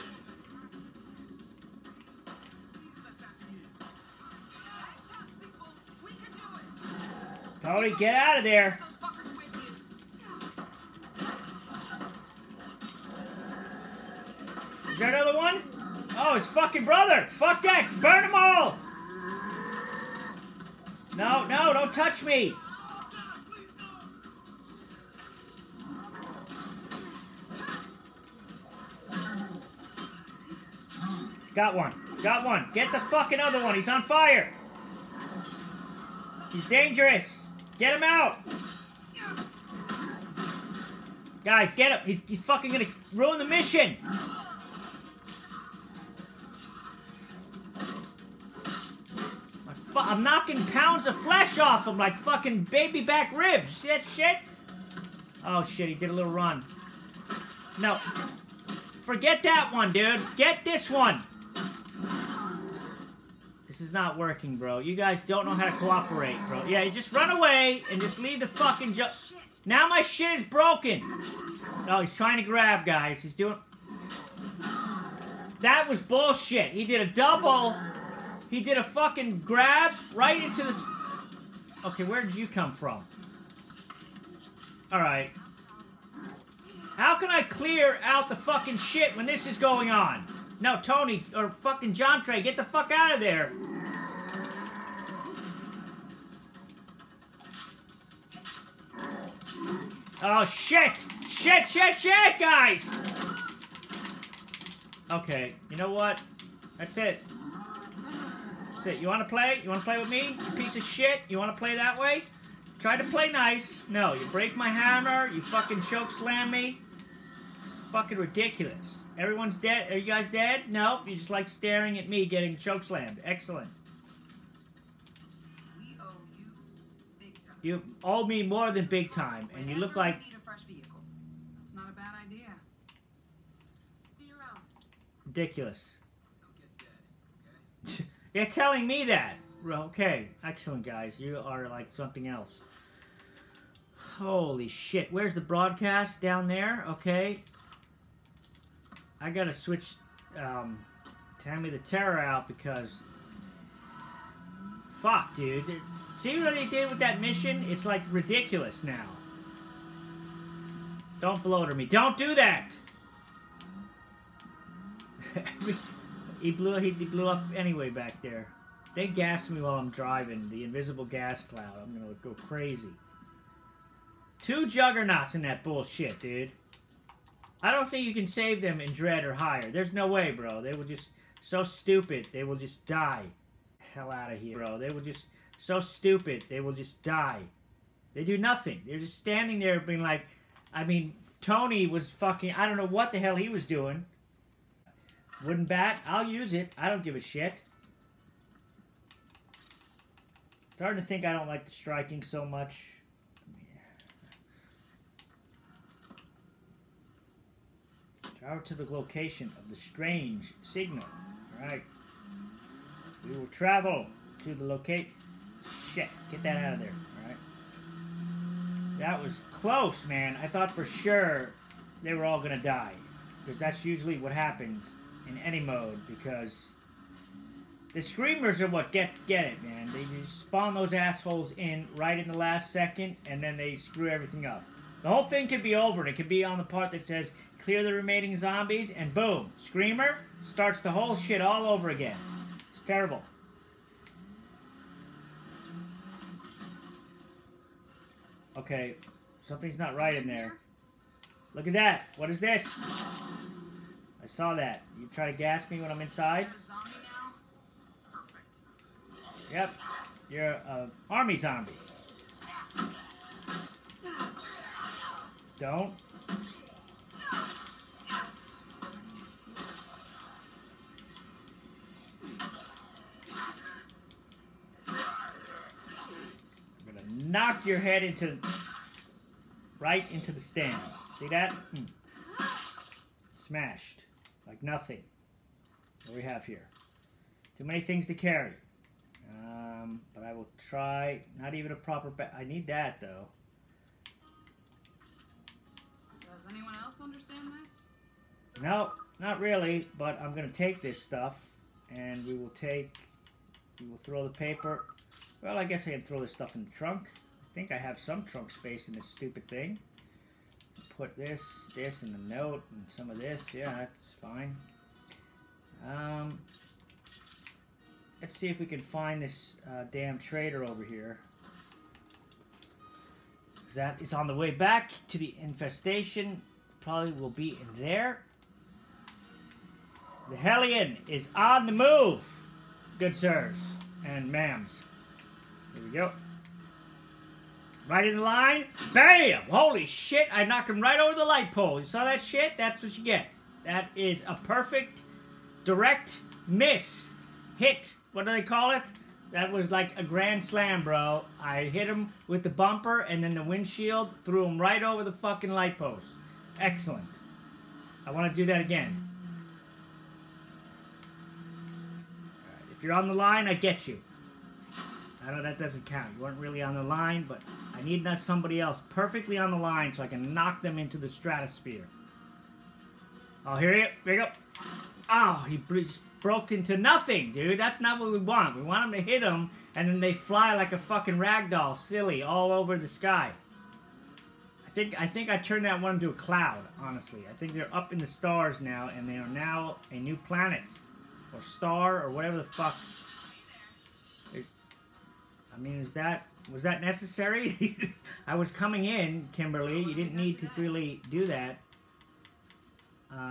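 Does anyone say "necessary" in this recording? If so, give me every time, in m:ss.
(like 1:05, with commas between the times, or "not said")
6:36.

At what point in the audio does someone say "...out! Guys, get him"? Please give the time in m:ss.
0:38.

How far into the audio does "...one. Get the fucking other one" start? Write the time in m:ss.
0:32.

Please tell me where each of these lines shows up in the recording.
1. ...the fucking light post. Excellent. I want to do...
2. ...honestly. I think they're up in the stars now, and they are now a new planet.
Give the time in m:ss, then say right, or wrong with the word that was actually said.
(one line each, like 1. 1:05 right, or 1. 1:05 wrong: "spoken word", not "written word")
1. 5:55 right
2. 6:26 right.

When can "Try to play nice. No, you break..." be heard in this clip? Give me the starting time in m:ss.
1:52.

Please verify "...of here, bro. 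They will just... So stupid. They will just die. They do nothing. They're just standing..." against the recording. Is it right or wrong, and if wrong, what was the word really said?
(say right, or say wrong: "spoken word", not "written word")
right.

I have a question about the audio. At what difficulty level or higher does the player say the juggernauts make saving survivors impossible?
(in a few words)
Dread.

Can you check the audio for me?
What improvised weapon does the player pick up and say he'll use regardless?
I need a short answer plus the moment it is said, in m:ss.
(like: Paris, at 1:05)
Wooden bat, at 3:15.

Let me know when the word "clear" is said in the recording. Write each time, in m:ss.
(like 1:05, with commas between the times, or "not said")
1:27, 3:57.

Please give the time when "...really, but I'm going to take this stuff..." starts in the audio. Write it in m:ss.
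4:59.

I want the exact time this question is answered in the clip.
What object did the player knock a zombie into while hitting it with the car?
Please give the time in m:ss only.
5:41.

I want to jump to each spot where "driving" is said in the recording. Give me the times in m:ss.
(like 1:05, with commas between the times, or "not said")
2:49.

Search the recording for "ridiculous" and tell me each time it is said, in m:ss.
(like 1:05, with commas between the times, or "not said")
1:58, 2:15, 2:38.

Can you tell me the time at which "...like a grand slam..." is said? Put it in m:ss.
5:49.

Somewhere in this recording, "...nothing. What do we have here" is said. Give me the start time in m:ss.
4:44.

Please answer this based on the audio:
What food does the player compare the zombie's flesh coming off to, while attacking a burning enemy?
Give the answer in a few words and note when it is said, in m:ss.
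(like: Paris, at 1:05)
baby back ribs, at 0:52.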